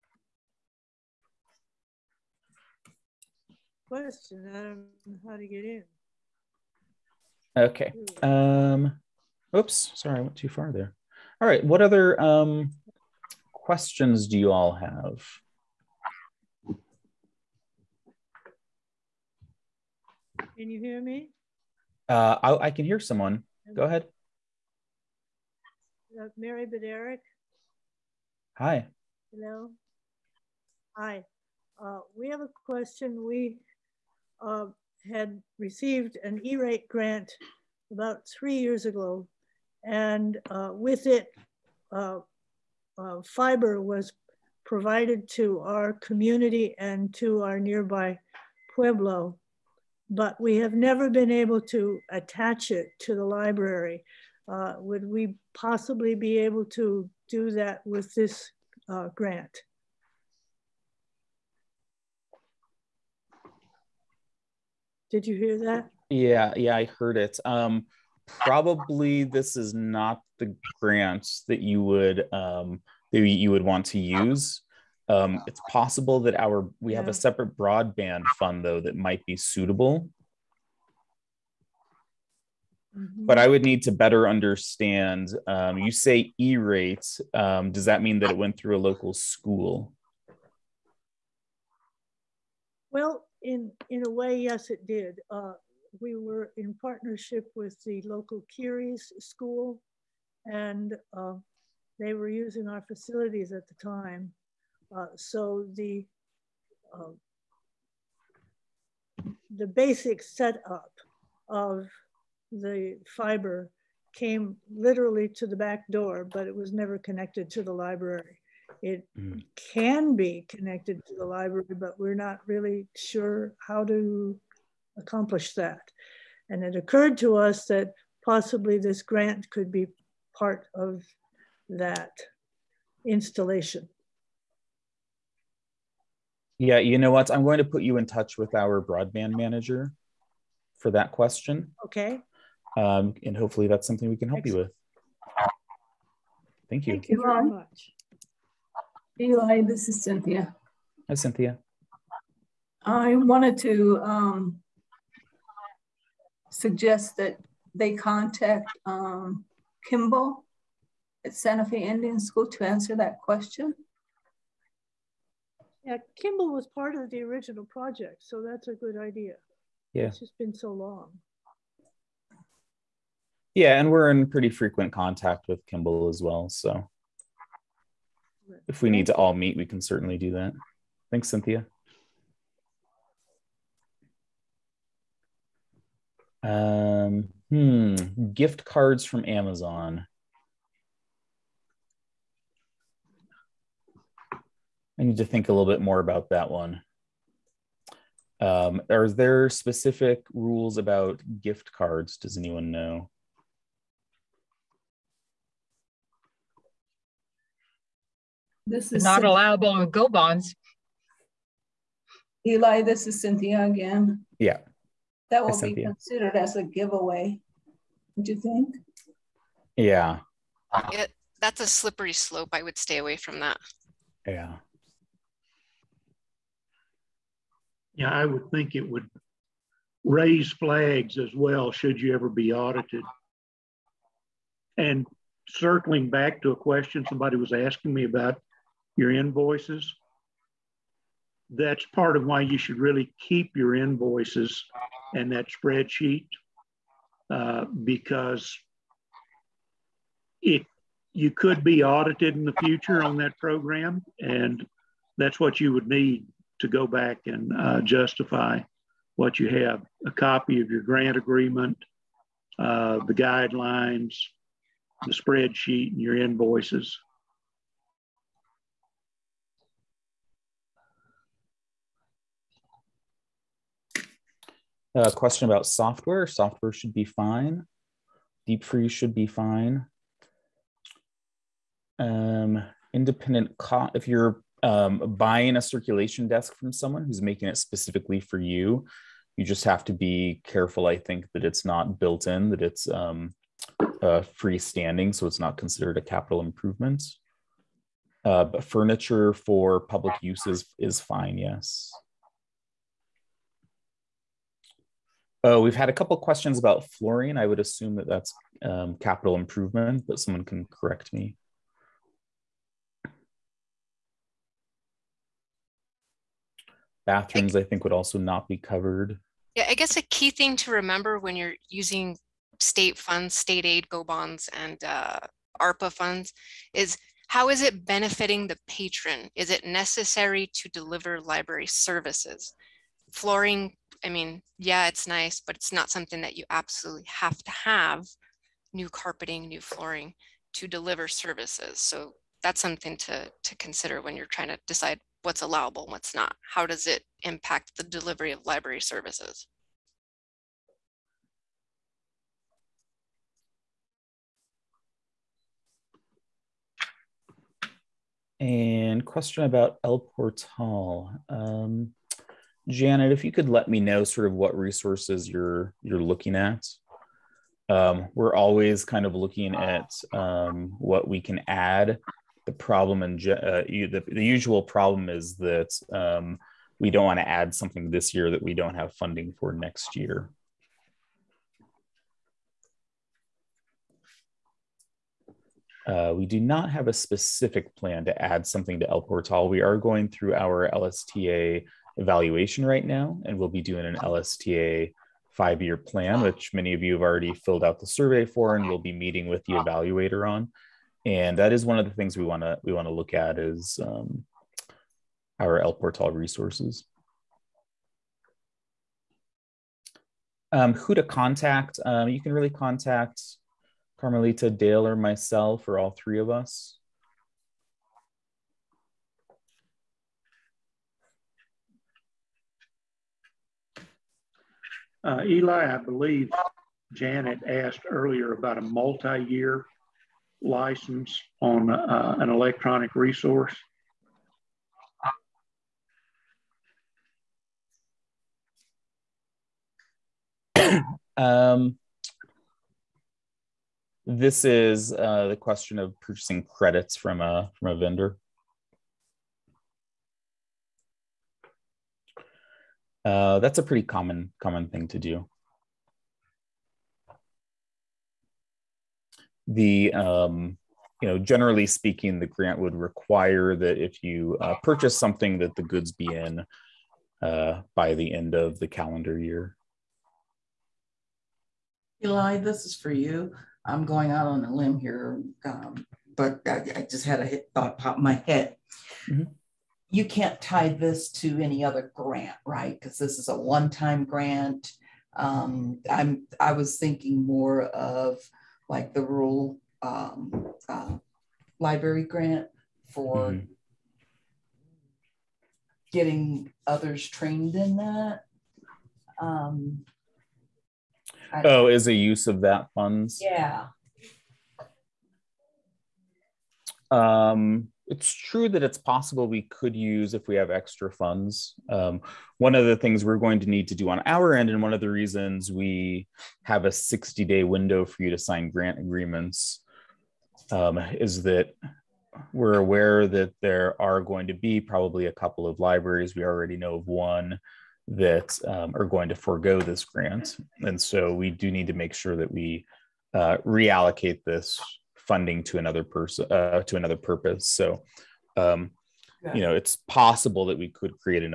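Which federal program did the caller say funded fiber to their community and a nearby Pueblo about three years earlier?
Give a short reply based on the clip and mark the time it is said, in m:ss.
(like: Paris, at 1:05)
E-rate, at 0:36.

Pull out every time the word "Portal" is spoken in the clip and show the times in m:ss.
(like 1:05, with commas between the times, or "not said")
5:59, 6:29, 6:45.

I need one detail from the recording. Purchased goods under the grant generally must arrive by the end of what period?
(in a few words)
calendar year.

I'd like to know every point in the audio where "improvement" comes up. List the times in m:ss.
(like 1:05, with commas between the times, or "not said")
4:56, 5:09.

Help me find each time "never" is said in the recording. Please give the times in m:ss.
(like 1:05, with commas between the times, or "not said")
0:50, 1:56.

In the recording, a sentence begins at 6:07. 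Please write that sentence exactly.
Um, we're always kind of looking at um, what we can add.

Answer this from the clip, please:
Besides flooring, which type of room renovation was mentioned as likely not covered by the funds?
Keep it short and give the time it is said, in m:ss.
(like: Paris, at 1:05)
Bathrooms, at 5:17.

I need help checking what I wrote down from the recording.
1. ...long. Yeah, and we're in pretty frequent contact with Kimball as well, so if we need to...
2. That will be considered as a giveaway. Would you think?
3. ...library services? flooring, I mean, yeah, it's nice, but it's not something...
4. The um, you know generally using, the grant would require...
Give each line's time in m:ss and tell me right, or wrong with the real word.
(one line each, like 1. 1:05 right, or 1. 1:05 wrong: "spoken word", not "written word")
1. 2:50 right
2. 3:35 right
3. 5:31 right
4. 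7:39 wrong: "speaking", not "using".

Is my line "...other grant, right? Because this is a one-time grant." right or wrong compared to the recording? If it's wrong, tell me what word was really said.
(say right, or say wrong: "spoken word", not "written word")
right.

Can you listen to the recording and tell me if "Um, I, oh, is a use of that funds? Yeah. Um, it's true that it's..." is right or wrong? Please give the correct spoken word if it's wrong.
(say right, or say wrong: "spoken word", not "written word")
right.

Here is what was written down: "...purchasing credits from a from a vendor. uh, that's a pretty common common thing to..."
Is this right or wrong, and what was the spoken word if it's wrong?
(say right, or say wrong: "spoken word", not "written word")
right.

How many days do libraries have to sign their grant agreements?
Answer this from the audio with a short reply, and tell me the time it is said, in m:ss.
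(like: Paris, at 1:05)
60, at 8:36.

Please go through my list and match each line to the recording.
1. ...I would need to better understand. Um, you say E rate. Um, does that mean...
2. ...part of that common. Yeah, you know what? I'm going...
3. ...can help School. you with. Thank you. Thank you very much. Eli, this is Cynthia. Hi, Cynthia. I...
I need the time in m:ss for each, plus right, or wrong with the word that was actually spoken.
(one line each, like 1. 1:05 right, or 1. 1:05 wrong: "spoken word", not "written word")
1. 1:23 right
2. 2:10 wrong: "installation", not "common"
3. 2:24 wrong: "Excellent", not "School".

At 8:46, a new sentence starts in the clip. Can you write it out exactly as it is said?
We already know of one that um, are going to forego this grant.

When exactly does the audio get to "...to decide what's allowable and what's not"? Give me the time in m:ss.
5:44.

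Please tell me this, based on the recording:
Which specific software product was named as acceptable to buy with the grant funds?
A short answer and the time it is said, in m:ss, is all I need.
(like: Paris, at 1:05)
Deep Freeze, at 4:38.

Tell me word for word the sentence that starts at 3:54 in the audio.
And circling back to a question somebody was asking me about your invoices.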